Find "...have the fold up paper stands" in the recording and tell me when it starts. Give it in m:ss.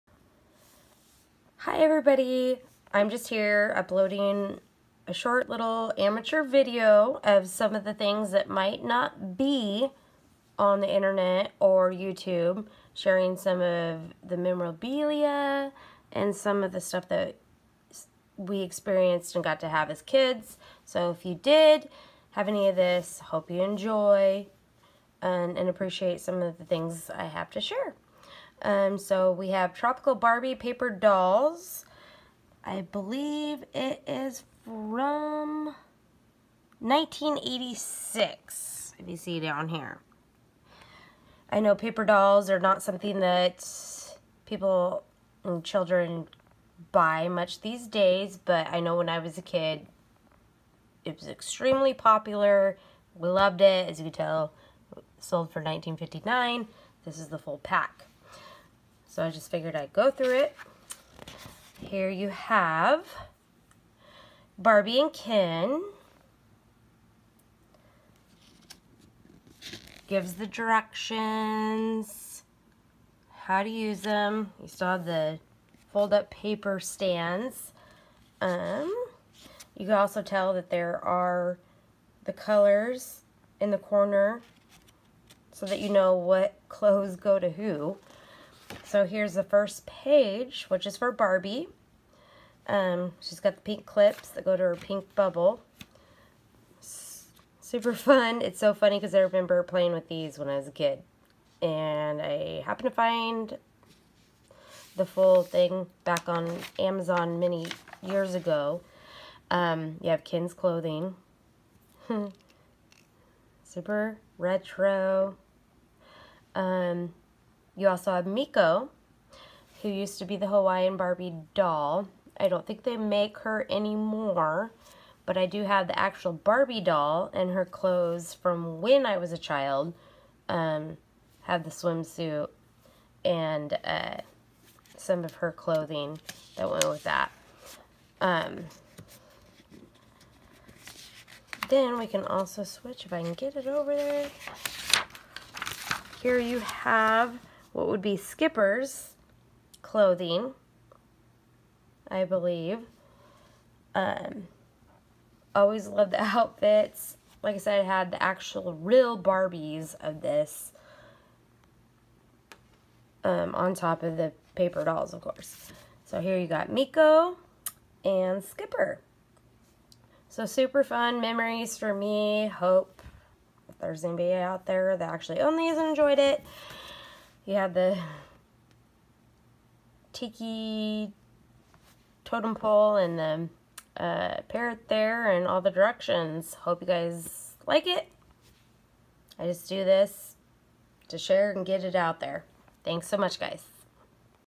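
1:14.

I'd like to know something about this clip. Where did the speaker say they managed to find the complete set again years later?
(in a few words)
Amazon.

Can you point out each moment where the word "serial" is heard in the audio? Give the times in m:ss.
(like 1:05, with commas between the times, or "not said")
not said.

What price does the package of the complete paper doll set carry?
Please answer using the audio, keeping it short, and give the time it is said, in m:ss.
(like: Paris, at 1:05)
19.59, at 0:55.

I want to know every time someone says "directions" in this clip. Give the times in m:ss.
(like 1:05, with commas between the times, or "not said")
1:10, 3:05.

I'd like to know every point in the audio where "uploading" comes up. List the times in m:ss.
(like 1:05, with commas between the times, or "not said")
0:03.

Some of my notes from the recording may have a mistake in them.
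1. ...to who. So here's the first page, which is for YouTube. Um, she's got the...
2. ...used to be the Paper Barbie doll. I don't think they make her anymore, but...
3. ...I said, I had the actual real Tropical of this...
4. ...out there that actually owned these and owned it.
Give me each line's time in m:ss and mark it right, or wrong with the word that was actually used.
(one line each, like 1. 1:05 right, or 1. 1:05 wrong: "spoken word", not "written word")
1. 1:27 wrong: "Barbie", not "YouTube"
2. 1:59 wrong: "Hawaiian", not "Paper"
3. 2:37 wrong: "Barbies", not "Tropical"
4. 2:54 wrong: "enjoyed", not "owned".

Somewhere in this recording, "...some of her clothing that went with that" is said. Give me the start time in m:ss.
2:14.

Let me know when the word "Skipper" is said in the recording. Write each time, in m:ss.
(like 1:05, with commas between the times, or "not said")
2:28, 2:48.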